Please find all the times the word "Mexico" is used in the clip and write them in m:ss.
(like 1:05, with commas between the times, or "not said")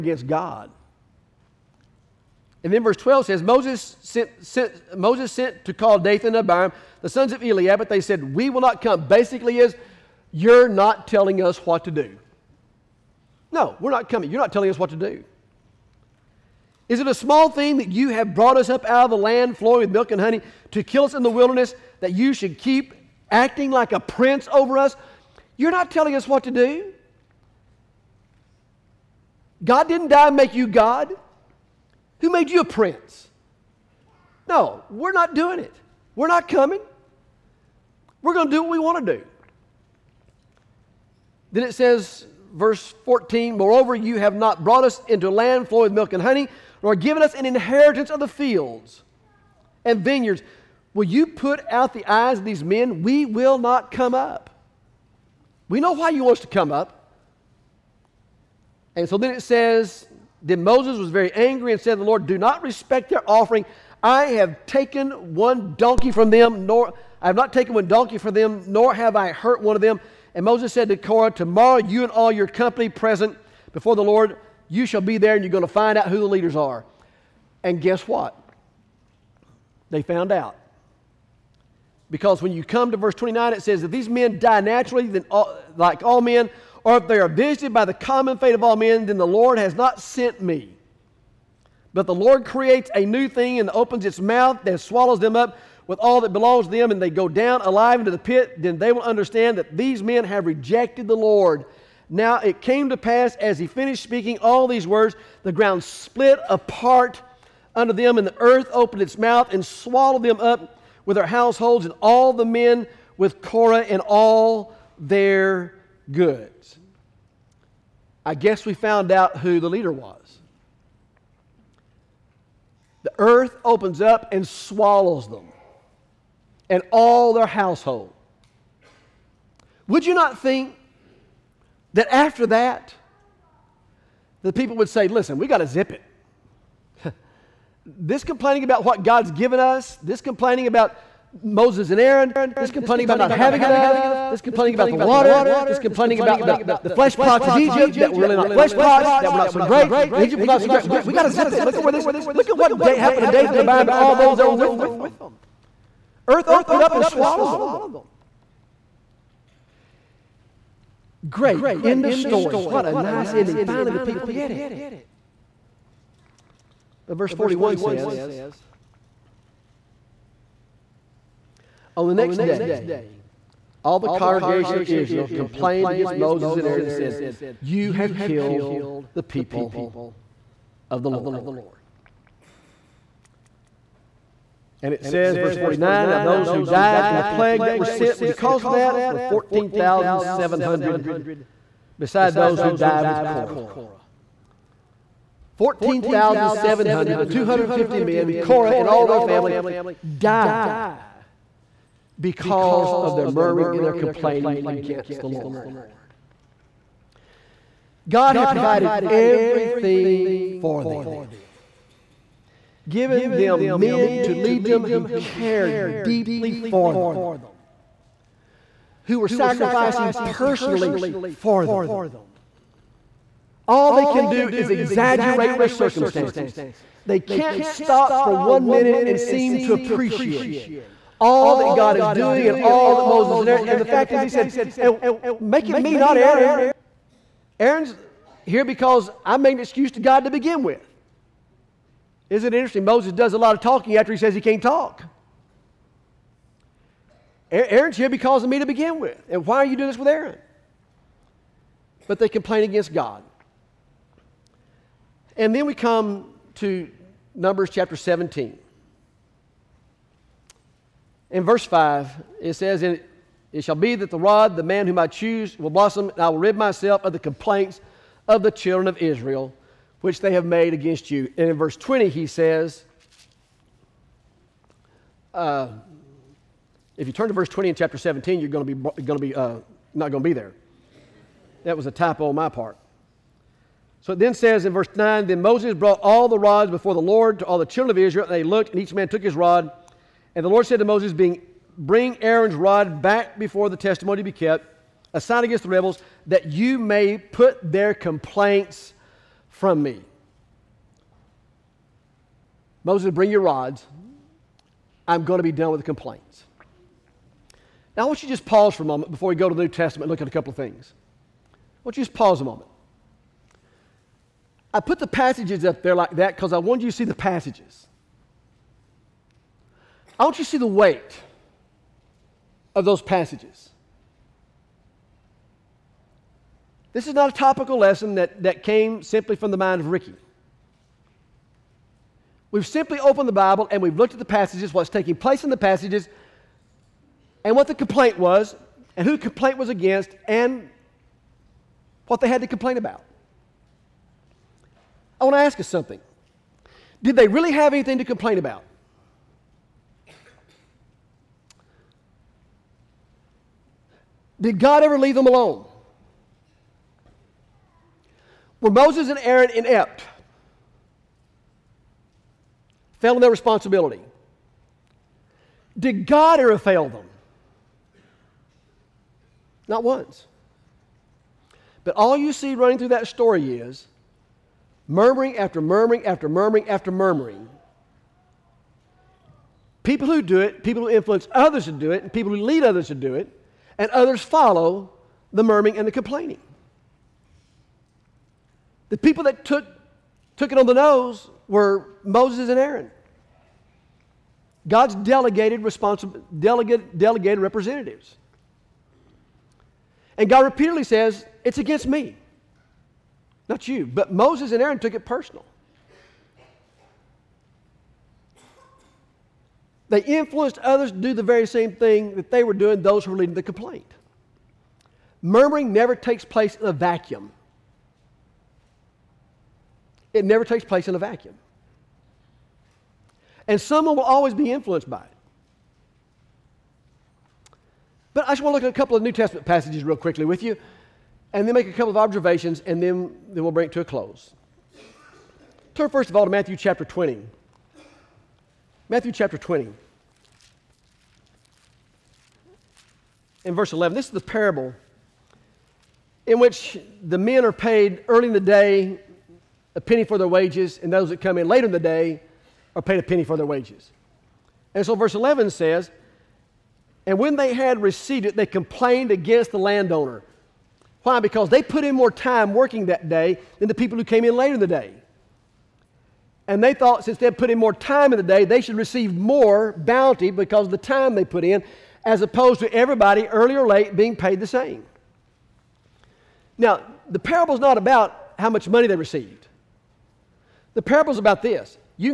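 not said.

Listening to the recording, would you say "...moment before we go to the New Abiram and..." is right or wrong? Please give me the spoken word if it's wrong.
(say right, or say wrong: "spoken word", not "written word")
wrong: "Testament", not "Abiram".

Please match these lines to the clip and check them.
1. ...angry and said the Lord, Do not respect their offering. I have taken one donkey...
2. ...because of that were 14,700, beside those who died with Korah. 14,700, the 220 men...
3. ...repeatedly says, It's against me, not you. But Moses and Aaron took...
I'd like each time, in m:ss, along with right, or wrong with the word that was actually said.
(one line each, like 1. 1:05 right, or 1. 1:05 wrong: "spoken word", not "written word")
1. 1:01 right
2. 3:08 wrong: "250", not "220"
3. 6:40 right.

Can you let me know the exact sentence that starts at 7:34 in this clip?
And so verse 11 says, And when they had received it, they complained against the landowner.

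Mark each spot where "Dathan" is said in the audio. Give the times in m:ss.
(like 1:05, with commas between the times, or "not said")
0:05, 2:33.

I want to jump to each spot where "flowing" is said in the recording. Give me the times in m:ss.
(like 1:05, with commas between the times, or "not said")
0:19, 0:45.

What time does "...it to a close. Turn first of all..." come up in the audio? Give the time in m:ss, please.
7:13.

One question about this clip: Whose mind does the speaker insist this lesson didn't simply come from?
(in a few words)
Rickie.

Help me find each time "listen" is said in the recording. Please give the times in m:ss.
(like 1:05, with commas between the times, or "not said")
2:15.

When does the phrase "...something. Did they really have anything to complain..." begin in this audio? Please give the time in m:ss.
5:45.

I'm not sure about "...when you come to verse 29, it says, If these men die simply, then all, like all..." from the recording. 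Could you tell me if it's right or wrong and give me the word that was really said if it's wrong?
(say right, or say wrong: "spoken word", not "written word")
wrong: "naturally", not "simply".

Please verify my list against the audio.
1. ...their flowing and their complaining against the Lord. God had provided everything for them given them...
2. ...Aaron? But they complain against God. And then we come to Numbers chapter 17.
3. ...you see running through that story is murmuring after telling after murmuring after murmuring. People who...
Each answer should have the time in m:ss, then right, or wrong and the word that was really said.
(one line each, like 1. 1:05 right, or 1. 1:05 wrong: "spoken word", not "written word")
1. 3:23 wrong: "murmuring", not "flowing"
2. 4:10 right
3. 6:12 wrong: "murmuring", not "telling".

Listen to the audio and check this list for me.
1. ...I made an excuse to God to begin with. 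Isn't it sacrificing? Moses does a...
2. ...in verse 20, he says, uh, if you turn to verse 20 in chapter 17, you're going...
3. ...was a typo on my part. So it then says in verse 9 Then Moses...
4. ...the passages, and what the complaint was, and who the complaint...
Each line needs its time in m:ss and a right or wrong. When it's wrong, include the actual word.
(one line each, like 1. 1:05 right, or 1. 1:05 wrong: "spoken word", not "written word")
1. 3:59 wrong: "interesting", not "sacrificing"
2. 4:31 right
3. 4:41 right
4. 5:35 right.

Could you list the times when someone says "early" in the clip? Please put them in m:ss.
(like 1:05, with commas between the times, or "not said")
7:28, 7:53.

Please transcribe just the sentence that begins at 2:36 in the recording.
Earth opened up and swallowed them.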